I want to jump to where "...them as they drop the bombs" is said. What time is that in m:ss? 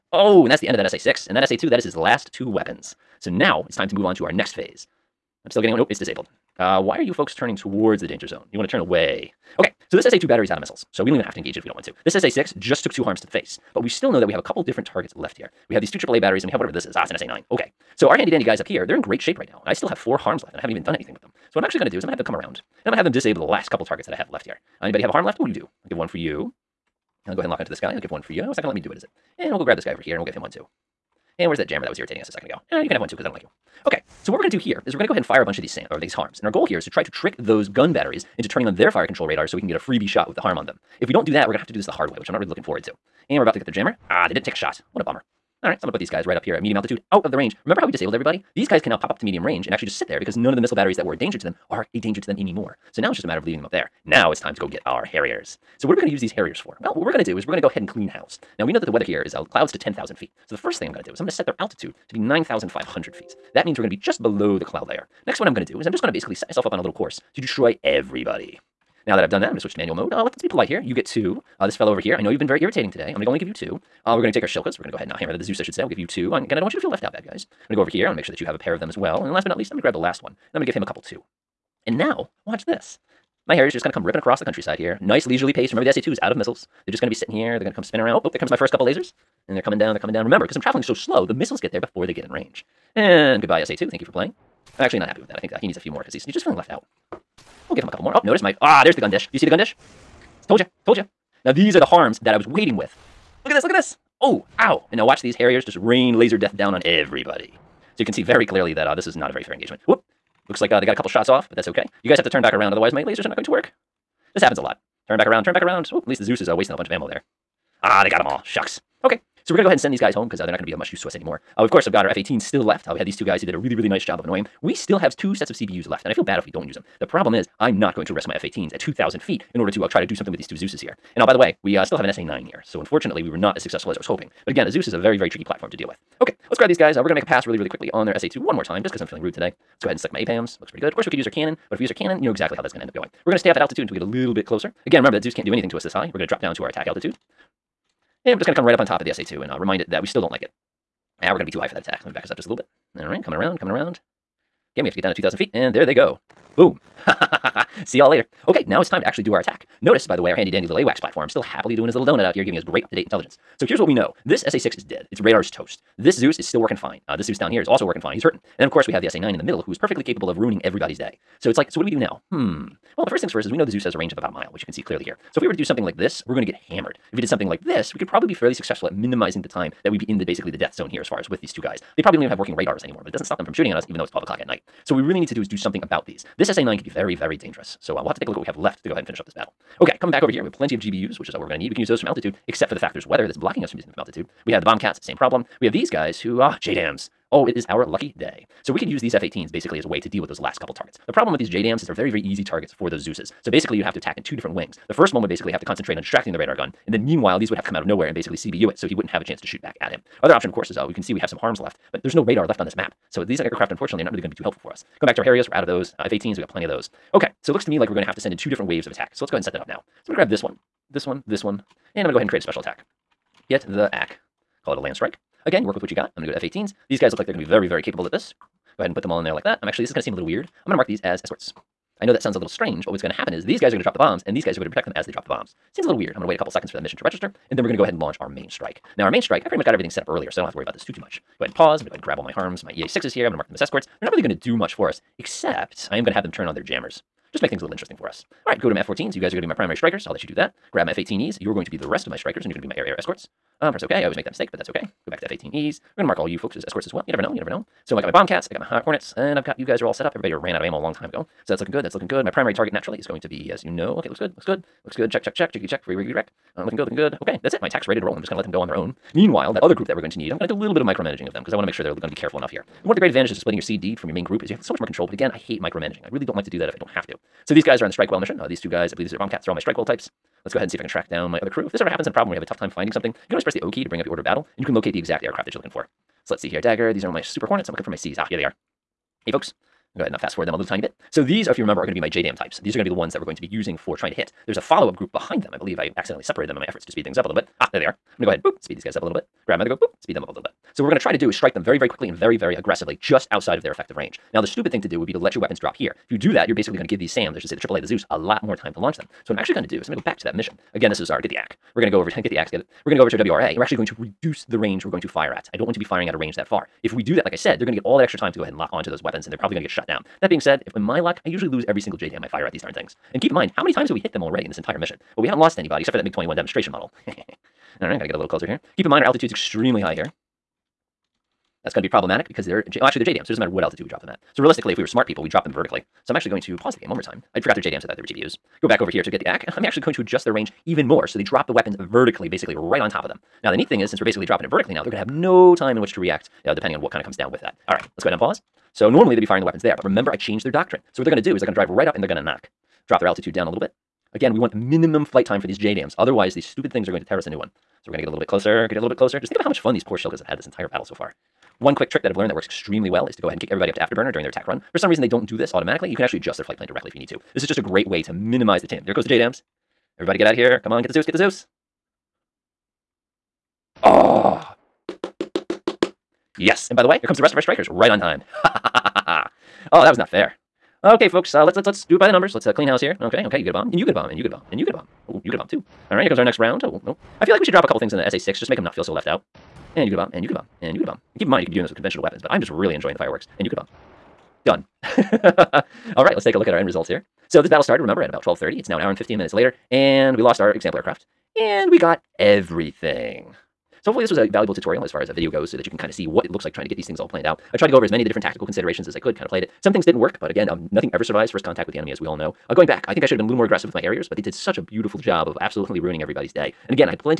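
3:54.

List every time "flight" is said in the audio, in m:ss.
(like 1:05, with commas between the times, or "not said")
5:55, 6:06.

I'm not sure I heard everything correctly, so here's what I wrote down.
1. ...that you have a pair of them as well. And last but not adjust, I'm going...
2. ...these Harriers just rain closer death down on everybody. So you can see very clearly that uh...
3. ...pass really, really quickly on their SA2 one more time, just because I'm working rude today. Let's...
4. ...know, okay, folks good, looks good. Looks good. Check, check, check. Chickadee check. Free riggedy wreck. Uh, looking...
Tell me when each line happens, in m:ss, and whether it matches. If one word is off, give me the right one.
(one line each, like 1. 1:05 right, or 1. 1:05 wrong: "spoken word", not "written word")
1. 1:18 wrong: "least", not "adjust"
2. 1:45 wrong: "laser", not "closer"
3. 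2:17 wrong: "feeling", not "working"
4. 4:23 wrong: "looks", not "folks".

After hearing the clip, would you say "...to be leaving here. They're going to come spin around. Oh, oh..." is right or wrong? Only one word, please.
wrong.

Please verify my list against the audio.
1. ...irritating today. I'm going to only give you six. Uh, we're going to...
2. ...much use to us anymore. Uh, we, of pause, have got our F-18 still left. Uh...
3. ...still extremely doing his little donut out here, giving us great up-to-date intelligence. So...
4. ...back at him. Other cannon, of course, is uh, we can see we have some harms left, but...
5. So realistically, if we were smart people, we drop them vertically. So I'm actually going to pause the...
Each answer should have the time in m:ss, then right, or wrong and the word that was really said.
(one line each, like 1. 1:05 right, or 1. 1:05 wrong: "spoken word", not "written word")
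1. 1:12 wrong: "two", not "six"
2. 2:00 wrong: "course", not "pause"
3. 2:41 wrong: "happily", not "extremely"
4. 3:29 wrong: "option", not "cannon"
5. 5:34 right.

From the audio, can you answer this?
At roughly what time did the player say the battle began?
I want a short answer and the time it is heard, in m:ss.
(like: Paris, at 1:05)
12:30, at 6:38.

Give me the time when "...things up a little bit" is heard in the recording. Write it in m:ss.
4:57.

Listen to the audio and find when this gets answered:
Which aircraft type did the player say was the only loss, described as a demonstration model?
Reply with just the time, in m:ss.
5:26.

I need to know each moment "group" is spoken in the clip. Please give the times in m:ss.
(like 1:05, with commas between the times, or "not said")
4:29, 4:34, 4:54.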